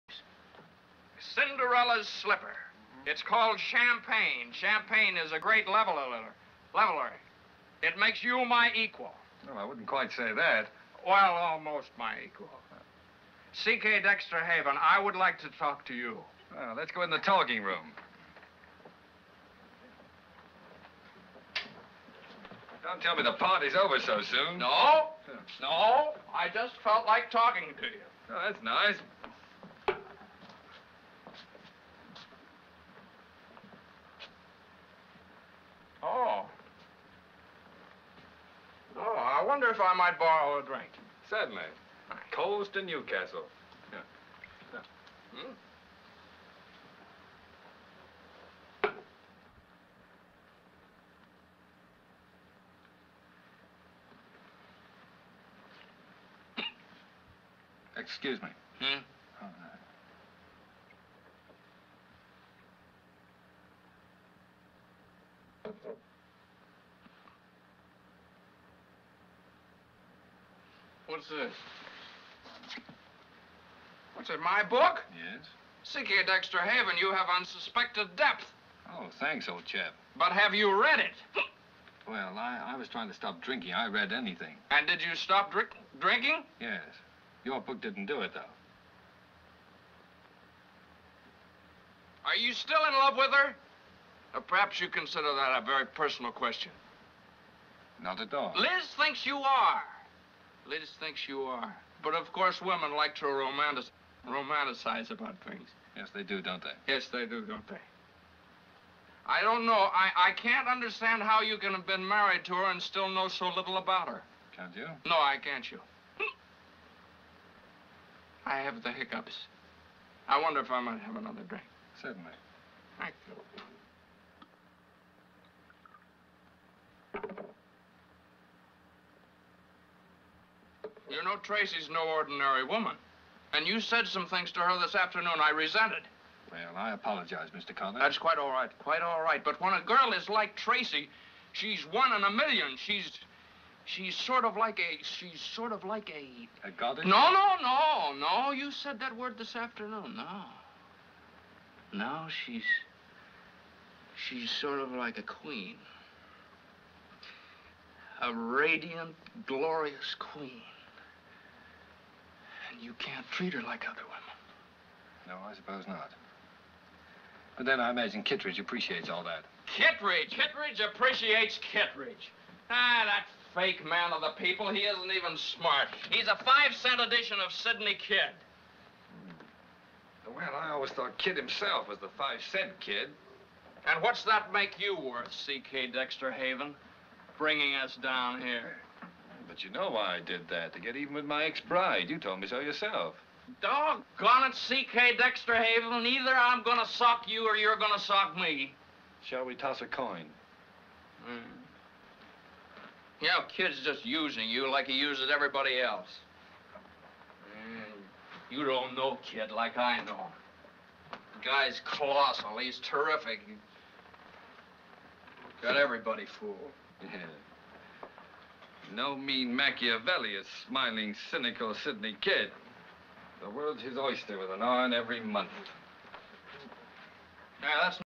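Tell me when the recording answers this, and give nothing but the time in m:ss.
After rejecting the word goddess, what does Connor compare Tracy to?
2:38.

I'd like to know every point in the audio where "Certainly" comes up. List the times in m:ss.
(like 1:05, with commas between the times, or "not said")
0:41, 2:02.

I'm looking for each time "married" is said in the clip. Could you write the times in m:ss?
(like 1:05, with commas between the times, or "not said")
1:52.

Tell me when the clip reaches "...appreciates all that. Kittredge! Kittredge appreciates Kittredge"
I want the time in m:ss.
2:48.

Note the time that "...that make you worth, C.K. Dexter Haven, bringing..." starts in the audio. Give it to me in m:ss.
3:04.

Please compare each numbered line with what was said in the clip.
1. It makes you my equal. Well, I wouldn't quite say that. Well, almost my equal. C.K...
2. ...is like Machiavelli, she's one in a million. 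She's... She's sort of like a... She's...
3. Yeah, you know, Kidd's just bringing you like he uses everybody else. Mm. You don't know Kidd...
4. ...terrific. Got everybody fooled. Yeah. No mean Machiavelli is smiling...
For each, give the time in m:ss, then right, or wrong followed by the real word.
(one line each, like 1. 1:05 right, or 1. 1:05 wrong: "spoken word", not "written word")
1. 0:07 right
2. 2:20 wrong: "Tracy", not "Machiavelli"
3. 3:23 wrong: "using", not "bringing"
4. 3:32 right.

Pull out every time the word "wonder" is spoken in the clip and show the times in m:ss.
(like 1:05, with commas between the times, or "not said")
0:39, 2:00.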